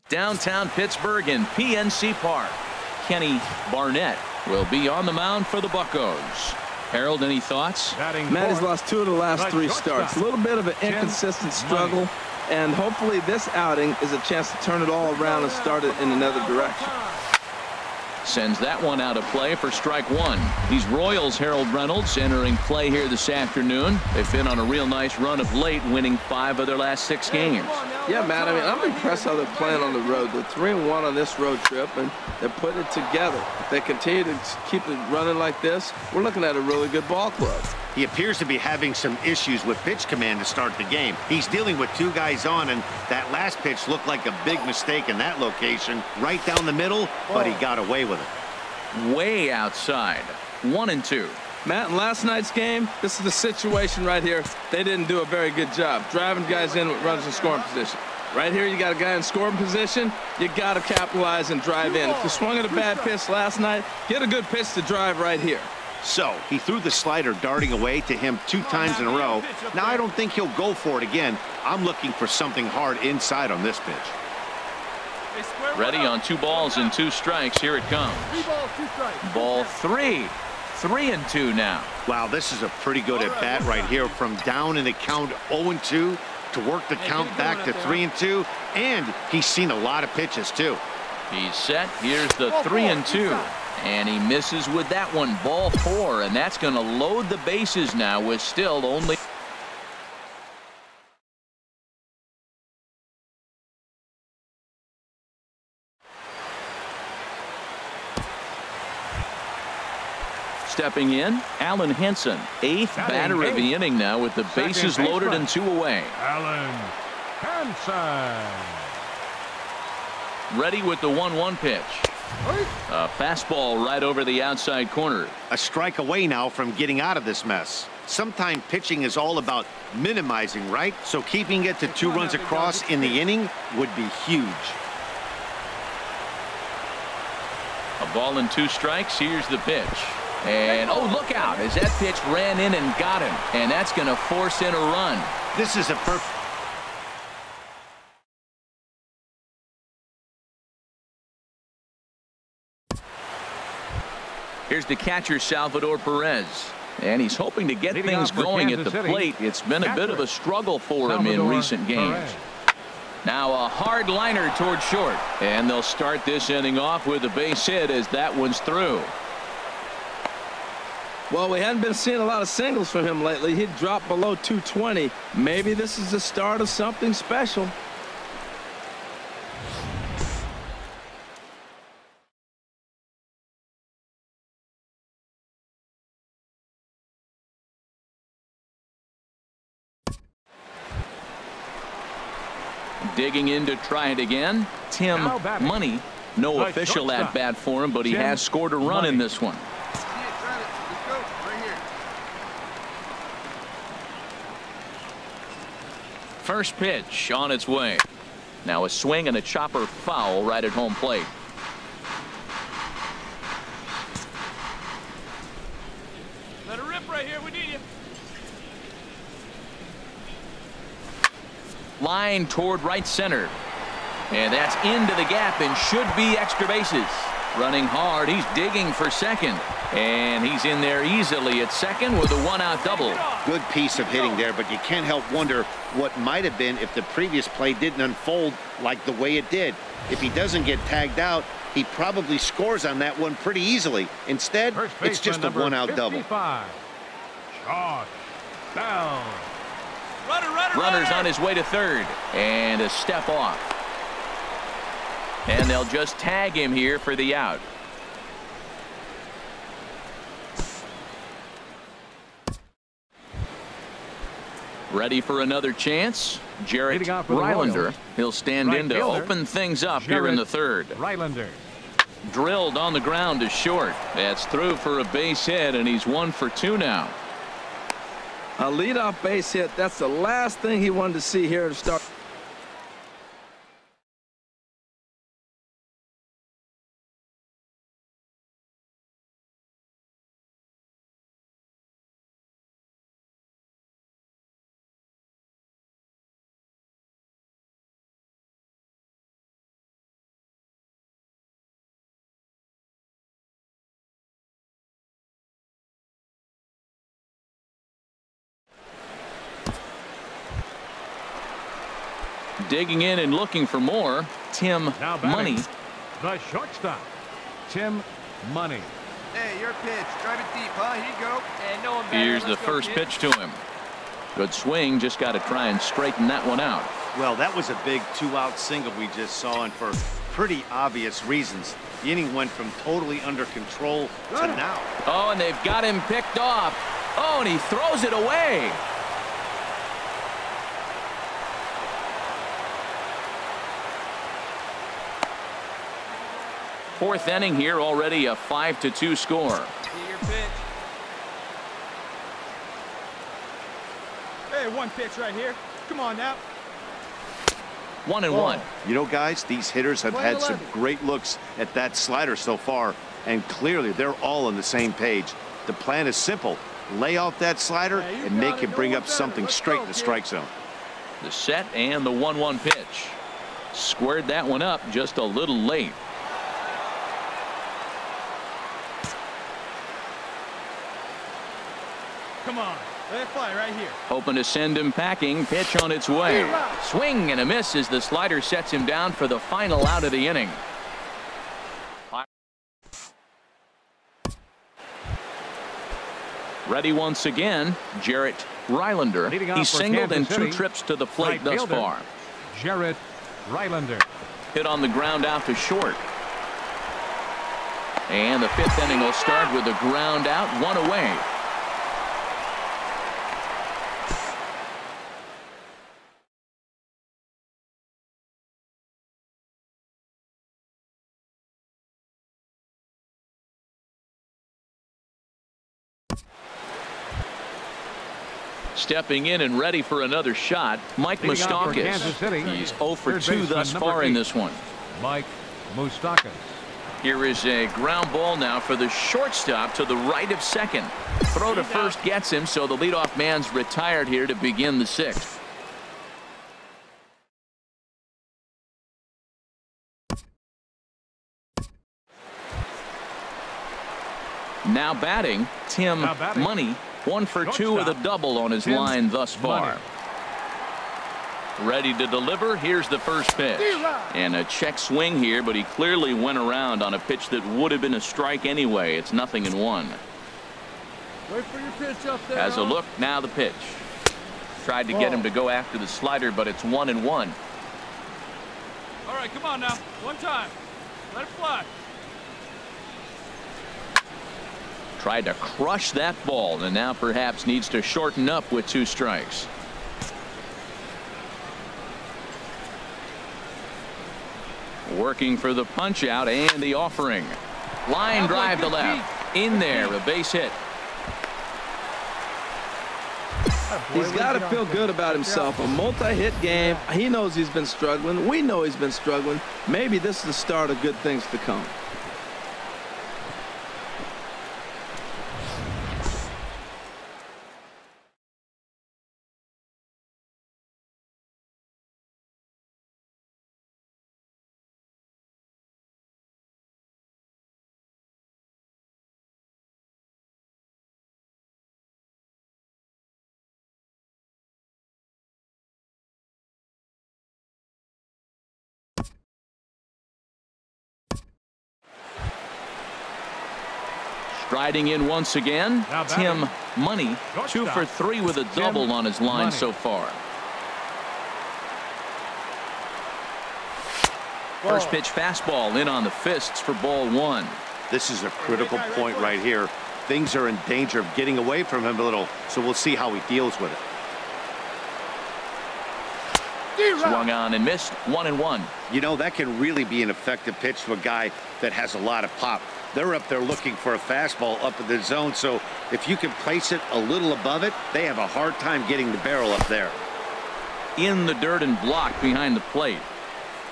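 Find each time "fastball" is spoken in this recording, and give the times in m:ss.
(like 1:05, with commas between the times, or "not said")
2:03, 9:15, 9:33.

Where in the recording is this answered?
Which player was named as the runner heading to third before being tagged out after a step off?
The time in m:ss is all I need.
4:06.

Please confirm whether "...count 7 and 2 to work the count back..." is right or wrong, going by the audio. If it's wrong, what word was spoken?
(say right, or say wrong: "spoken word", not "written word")
wrong: "0", not "7".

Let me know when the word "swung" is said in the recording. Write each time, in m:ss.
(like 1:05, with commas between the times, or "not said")
1:02, 9:26.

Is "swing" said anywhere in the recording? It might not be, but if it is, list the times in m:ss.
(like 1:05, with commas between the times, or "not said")
3:28, 5:24, 6:26, 7:44.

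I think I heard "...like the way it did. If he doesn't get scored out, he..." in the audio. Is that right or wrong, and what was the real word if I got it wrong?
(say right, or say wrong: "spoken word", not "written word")
wrong: "tagged", not "scored".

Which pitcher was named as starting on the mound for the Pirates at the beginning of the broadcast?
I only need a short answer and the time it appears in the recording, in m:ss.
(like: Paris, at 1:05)
Kenny Barnett, at 0:03.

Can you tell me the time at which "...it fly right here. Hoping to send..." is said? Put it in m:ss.
6:23.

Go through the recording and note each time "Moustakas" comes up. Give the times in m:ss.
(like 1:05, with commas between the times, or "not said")
7:11, 7:15.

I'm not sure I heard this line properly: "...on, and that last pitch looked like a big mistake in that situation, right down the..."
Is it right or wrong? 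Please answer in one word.
wrong.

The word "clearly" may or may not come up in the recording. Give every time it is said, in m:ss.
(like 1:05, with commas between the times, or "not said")
6:03, 7:45.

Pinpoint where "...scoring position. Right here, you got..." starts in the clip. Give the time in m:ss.
0:57.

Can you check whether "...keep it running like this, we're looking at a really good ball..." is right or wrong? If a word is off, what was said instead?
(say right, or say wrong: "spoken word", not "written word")
right.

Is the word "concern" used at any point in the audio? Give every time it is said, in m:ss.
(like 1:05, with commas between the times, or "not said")
not said.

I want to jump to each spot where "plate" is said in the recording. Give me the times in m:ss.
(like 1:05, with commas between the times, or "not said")
2:39, 3:30, 6:41, 9:42.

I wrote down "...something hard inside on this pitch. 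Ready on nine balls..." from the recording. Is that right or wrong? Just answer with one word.
wrong.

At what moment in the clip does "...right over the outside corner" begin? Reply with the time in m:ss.
2:03.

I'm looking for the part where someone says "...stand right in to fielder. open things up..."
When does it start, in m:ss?
4:28.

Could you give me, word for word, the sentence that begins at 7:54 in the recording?
Tried to get him to go after the slider, but it's one and one.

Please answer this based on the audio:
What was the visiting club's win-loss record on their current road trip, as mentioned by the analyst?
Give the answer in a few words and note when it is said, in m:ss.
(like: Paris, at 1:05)
3 and 1, at 0:30.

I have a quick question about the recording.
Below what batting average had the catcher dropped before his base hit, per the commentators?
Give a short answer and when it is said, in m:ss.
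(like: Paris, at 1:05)
220, at 2:54.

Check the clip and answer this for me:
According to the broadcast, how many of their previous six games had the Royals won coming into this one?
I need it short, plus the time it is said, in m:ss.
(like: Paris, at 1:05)
5, at 0:26.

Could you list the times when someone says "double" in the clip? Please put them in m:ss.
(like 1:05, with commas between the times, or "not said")
3:52, 4:05, 7:37, 9:08.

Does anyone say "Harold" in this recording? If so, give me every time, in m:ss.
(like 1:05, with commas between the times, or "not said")
0:06, 0:21.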